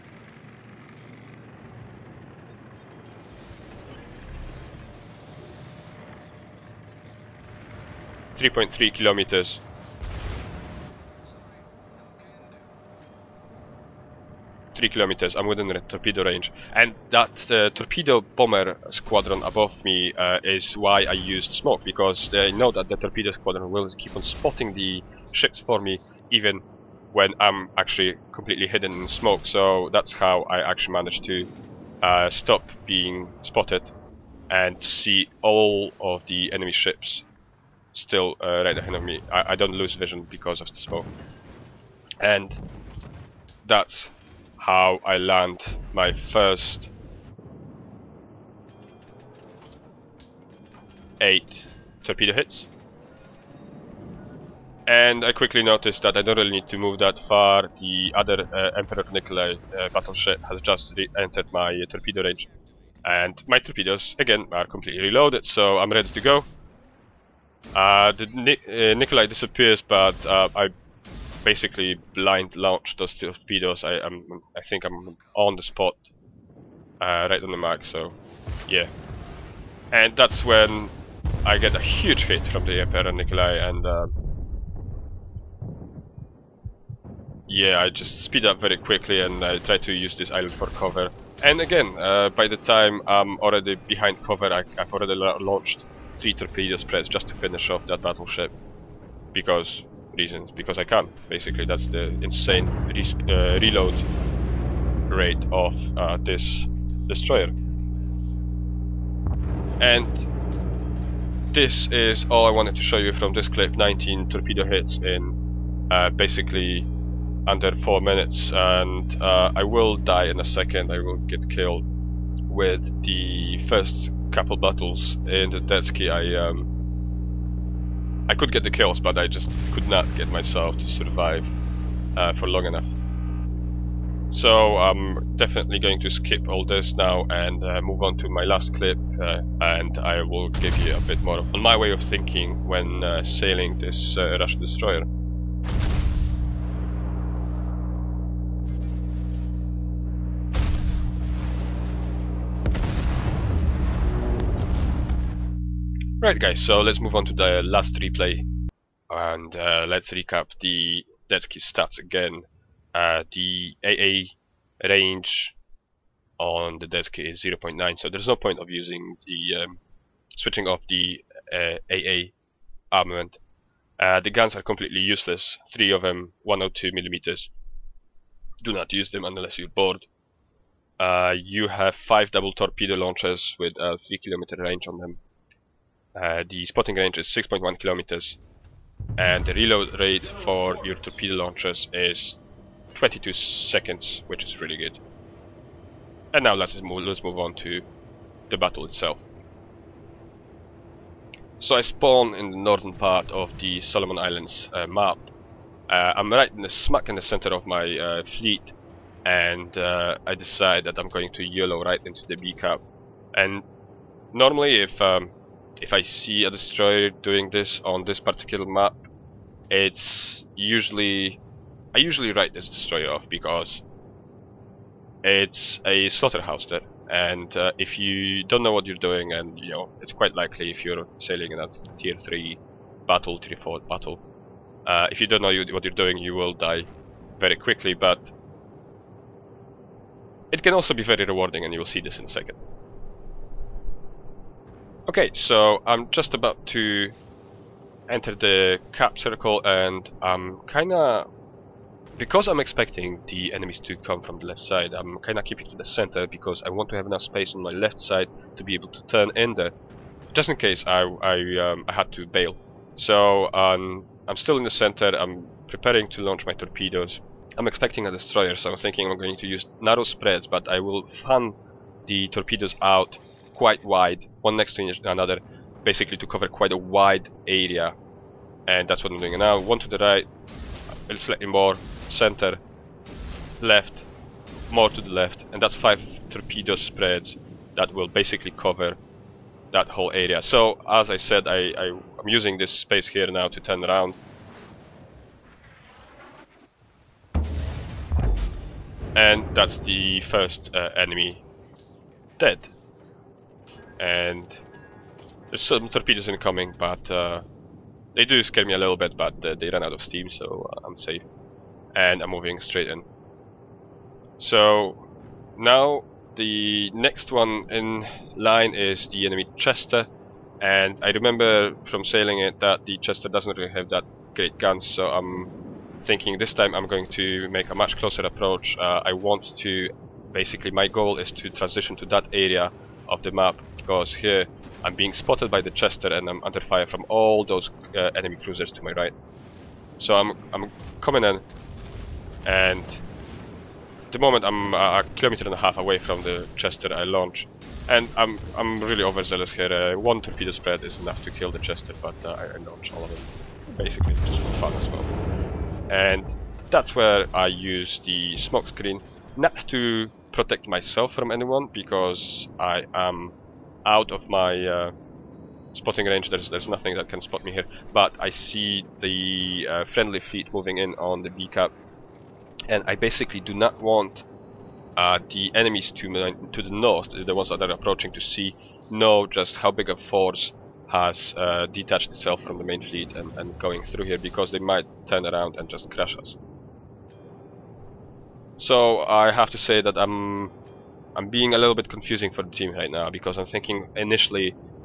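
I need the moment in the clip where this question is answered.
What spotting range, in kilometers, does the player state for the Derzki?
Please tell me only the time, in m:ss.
3:07.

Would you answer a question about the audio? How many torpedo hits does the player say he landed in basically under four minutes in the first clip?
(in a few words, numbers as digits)
19.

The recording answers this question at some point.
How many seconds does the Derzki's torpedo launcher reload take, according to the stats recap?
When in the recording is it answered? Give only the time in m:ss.
3:12.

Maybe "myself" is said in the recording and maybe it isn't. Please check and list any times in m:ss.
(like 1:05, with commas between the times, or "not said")
2:10, 6:00.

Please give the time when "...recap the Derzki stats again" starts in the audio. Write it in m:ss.
2:40.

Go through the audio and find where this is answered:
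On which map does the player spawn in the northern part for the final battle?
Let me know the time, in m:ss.
3:23.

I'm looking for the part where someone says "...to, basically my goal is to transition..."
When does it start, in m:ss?
5:29.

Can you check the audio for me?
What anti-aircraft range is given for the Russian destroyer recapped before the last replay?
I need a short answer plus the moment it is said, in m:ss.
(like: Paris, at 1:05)
0.9, at 2:47.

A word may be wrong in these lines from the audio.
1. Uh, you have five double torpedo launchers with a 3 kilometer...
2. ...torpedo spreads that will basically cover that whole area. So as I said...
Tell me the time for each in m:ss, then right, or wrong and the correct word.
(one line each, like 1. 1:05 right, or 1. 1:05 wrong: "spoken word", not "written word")
1. 3:00 right
2. 4:46 right.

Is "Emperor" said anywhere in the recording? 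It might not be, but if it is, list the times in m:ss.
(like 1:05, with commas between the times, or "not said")
0:58, 1:22.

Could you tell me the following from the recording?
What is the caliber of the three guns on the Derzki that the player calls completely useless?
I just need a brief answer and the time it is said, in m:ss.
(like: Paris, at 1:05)
102 millimeters, at 2:56.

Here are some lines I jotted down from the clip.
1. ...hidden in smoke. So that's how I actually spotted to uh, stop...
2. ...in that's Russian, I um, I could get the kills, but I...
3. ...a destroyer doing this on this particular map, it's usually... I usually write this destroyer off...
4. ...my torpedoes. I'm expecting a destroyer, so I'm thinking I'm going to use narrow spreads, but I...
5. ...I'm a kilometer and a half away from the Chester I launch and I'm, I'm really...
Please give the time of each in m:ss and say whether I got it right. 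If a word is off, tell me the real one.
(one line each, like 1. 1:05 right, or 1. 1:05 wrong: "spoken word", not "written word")
1. 0:28 wrong: "managed", not "spotted"
2. 2:05 wrong: "Derzki", not "Russian"
3. 3:36 right
4. 4:26 right
5. 5:44 right.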